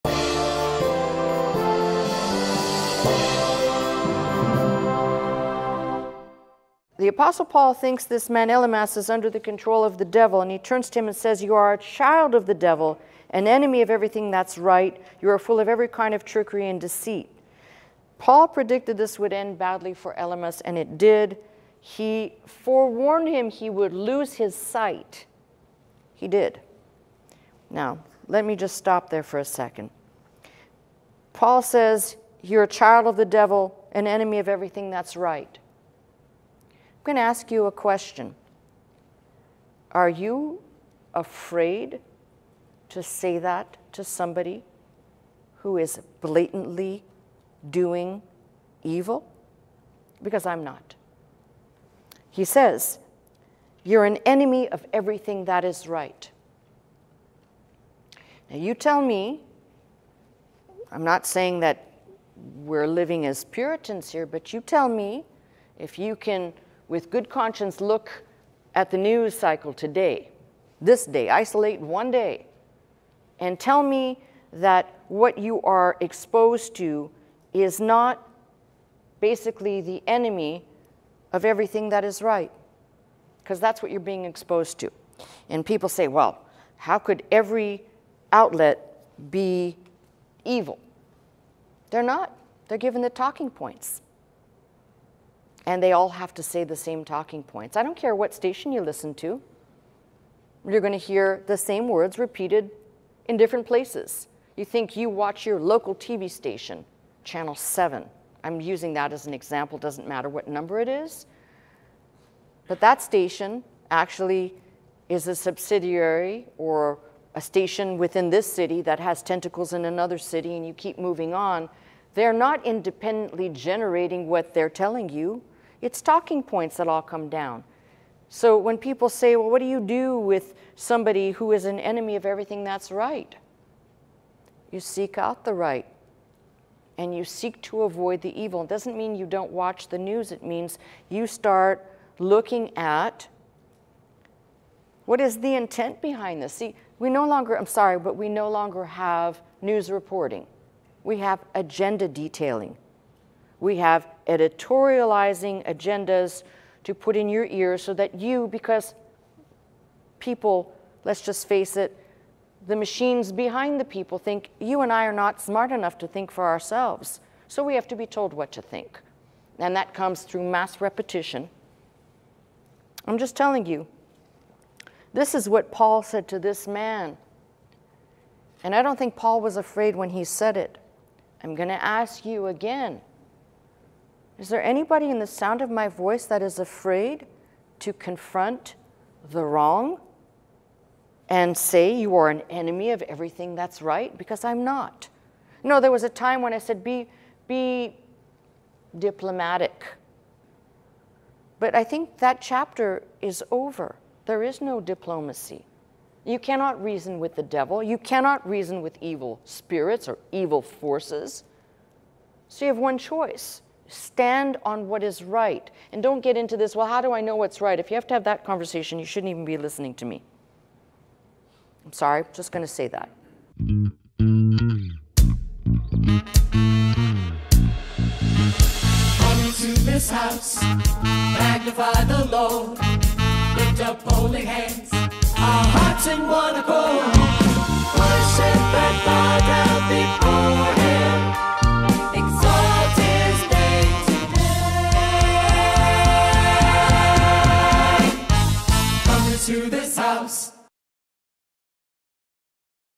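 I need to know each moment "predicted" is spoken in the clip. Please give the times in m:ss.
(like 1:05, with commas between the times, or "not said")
0:18.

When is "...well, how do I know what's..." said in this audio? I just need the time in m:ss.
3:36.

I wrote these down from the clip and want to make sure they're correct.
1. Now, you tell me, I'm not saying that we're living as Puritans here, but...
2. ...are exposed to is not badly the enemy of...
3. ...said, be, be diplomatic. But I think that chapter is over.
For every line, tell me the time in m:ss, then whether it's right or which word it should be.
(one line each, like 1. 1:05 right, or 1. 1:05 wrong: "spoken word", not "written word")
1. 0:58 right
2. 1:15 wrong: "basically", not "badly"
3. 3:16 right.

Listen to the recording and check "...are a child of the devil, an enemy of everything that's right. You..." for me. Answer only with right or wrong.
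right.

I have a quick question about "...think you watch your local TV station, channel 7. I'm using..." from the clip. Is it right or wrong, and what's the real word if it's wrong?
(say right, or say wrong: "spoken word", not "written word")
right.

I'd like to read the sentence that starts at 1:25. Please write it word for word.
And people say, well, how could every outlet be evil?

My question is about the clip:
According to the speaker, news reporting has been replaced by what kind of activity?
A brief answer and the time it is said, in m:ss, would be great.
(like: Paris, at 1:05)
agenda detailing, at 2:31.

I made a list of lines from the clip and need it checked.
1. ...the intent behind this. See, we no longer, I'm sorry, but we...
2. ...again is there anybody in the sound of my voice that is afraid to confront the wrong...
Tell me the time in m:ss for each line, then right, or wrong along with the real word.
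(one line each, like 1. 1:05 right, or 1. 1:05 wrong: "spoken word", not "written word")
1. 2:25 right
2. 3:02 right.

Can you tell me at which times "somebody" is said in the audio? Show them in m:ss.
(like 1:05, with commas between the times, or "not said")
0:44, 2:10.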